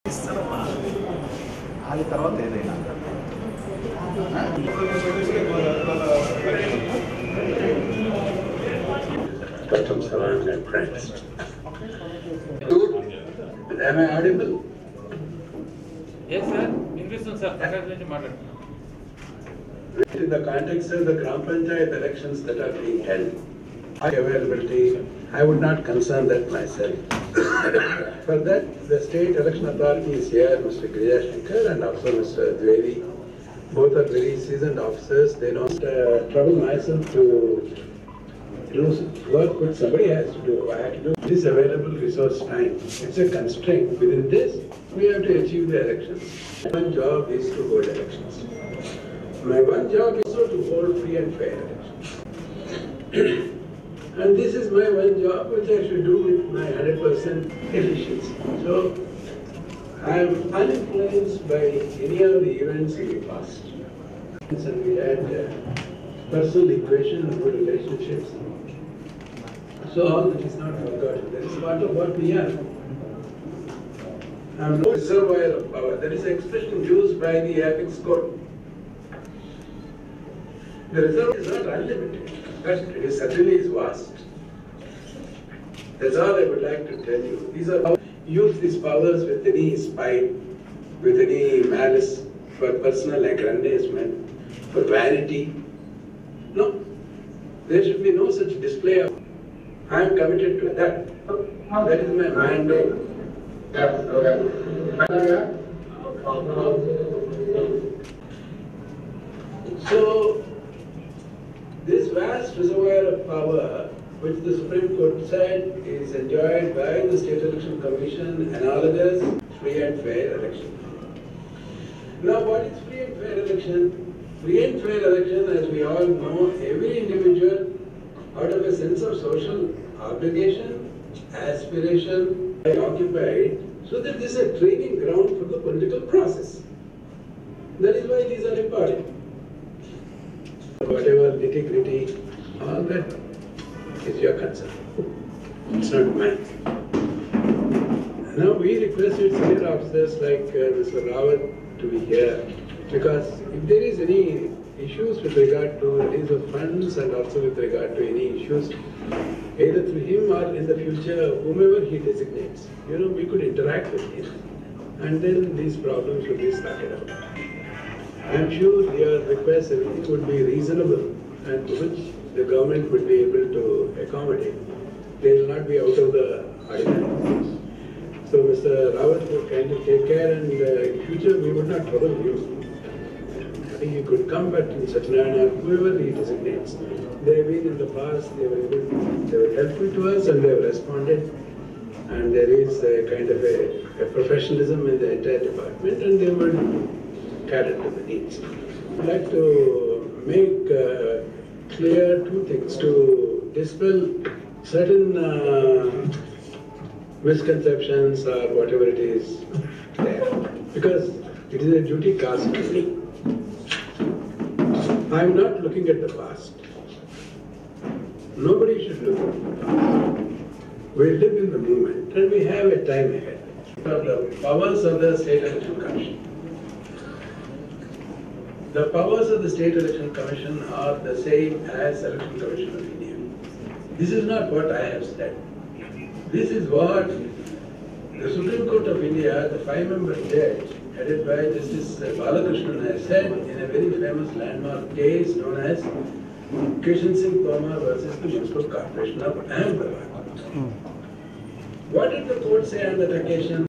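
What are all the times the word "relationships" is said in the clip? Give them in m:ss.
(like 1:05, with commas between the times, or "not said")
1:07.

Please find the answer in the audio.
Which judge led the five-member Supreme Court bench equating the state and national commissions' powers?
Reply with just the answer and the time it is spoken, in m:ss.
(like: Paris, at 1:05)
Justice Balakrishnan, at 4:01.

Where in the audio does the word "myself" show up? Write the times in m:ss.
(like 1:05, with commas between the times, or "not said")
0:26, 0:36.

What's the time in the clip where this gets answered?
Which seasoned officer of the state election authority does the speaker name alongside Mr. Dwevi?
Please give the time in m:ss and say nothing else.
0:30.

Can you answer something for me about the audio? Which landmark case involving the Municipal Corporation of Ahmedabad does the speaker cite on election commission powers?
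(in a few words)
Kishan Singh Tomar.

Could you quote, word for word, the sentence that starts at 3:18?
I'd like to make uh, clear two things to dispel certain uh, misconceptions or whatever it is there.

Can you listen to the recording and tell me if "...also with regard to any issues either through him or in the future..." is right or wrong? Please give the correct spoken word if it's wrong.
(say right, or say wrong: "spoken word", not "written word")
right.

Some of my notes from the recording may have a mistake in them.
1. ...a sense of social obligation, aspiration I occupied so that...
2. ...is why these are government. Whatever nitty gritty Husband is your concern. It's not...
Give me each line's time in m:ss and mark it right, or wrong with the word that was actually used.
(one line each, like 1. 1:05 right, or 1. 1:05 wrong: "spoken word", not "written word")
1. 2:08 right
2. 2:17 wrong: "important", not "government".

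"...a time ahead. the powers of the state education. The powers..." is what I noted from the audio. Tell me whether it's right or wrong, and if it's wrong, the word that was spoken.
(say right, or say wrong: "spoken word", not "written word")
right.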